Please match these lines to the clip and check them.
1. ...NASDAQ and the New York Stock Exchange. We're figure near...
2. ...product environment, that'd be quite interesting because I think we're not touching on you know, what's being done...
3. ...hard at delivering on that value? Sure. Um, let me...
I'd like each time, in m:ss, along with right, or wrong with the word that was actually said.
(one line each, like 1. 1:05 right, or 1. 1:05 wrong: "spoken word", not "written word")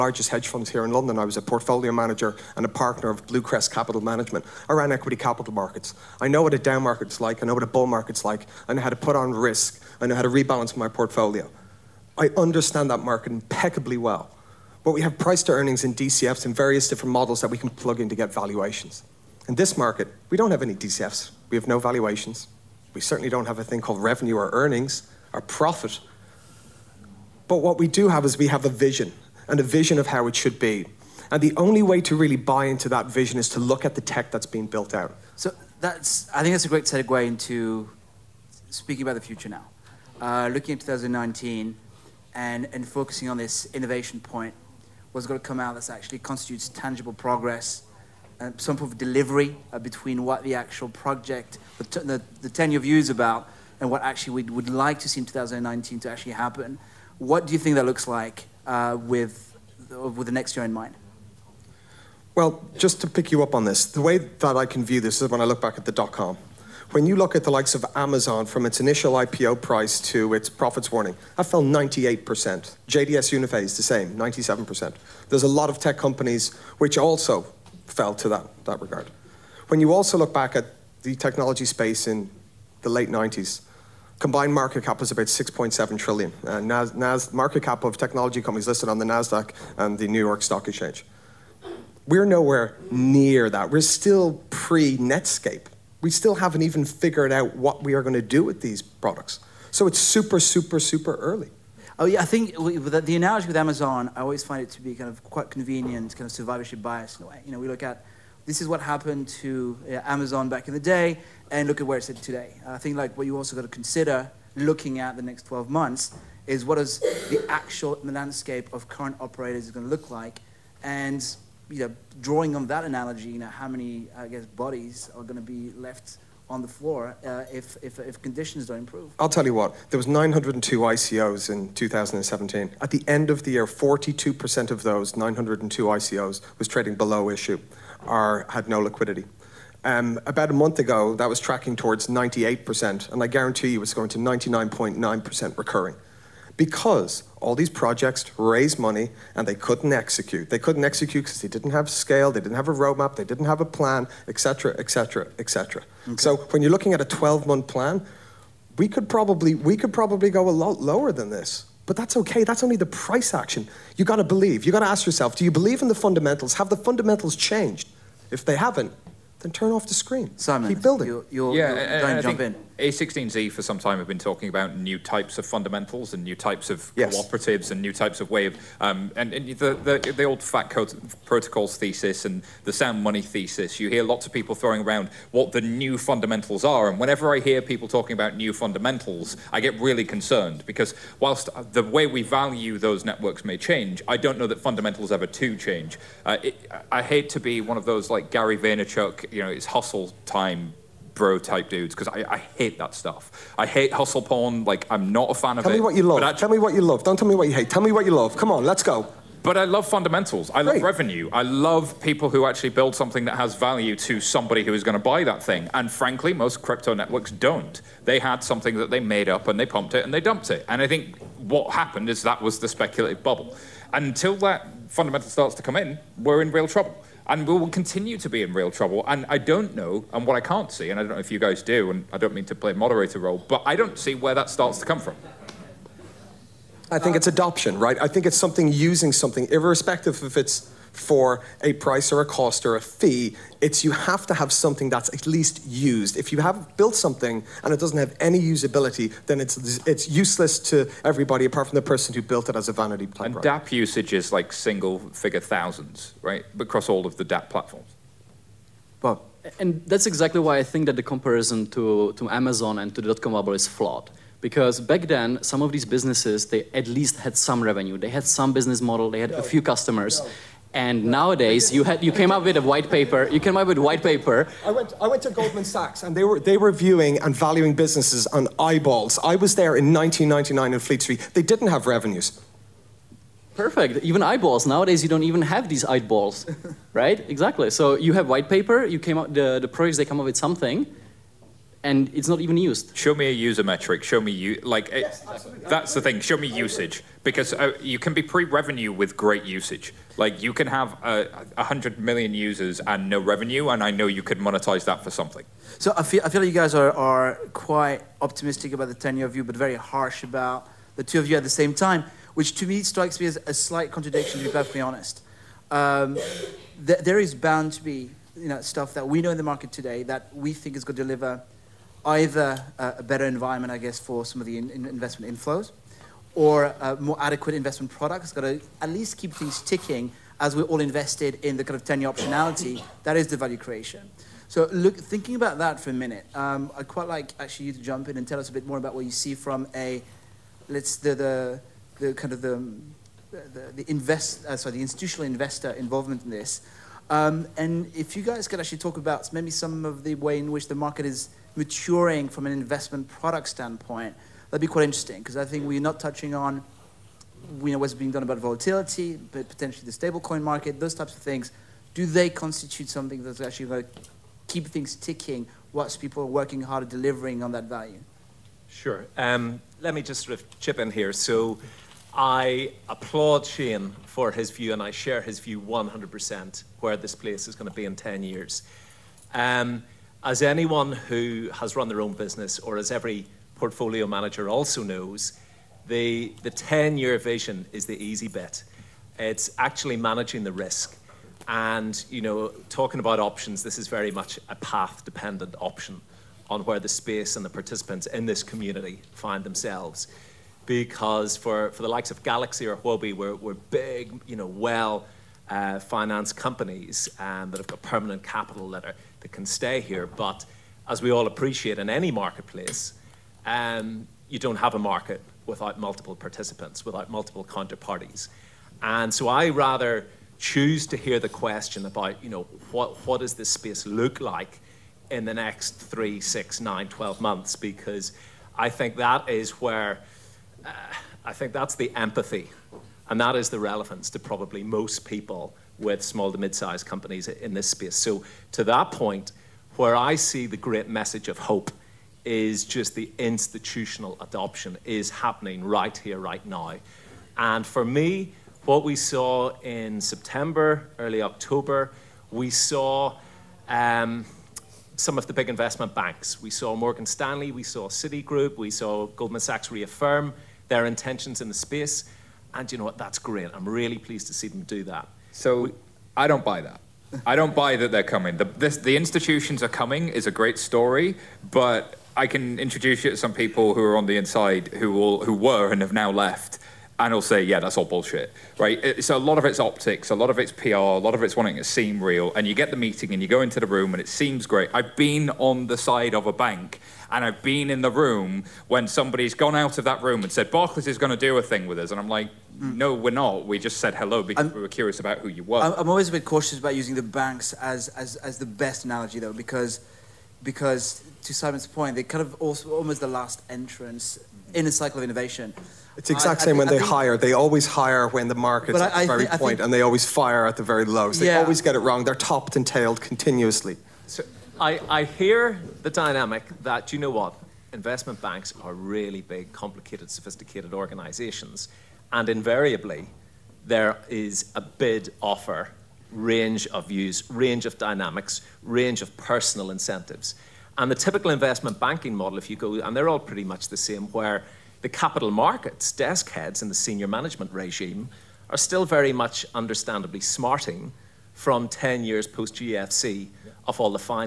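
1. 1:29 wrong: "nowhere", not "figure"
2. 5:53 wrong: "standpoint", not "environment"
3. 6:06 right.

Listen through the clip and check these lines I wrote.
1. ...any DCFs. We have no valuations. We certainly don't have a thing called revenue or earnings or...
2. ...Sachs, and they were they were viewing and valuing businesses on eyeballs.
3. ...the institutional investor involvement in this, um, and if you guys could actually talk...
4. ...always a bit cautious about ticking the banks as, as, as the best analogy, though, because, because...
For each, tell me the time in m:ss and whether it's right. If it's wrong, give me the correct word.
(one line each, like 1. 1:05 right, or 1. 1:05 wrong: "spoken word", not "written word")
1. 0:20 right
2. 4:35 right
3. 5:44 right
4. 8:15 wrong: "using", not "ticking".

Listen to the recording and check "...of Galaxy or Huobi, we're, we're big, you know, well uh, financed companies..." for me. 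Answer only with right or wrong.
right.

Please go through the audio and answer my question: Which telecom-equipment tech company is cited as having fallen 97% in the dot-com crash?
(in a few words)
JDS Uniphase.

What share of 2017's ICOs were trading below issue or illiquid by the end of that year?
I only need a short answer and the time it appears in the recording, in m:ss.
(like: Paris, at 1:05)
42%, at 2:13.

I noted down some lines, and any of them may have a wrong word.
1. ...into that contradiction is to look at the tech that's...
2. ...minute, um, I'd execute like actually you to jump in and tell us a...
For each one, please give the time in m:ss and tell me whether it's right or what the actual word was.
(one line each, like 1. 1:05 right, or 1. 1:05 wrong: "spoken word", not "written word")
1. 0:32 wrong: "vision", not "contradiction"
2. 5:35 wrong: "quite", not "execute".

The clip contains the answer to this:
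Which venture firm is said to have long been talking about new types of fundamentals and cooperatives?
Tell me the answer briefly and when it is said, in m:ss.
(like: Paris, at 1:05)
A16Z, at 2:52.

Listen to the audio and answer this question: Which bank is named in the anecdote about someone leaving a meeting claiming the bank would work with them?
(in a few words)
Barclays.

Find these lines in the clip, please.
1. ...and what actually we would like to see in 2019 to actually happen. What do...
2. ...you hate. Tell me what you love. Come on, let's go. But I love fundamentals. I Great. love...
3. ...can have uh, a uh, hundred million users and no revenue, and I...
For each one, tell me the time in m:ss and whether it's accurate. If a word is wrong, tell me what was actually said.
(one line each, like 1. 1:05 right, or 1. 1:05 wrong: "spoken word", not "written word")
1. 0:53 right
2. 3:27 right
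3. 5:00 right.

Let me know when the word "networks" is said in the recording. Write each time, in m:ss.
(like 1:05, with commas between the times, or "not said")
3:13, 3:36.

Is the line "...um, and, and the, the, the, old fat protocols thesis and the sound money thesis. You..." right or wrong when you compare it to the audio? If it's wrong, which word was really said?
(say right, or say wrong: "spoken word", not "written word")
right.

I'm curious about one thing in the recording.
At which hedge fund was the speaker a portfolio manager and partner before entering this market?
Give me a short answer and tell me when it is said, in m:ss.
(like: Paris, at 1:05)
Bluecrest Capital Management, at 0:03.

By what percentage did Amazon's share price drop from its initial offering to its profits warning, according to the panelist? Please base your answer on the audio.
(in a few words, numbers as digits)
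98%.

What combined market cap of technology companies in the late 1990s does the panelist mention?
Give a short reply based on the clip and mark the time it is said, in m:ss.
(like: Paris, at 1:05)
6.7 trillion, at 1:25.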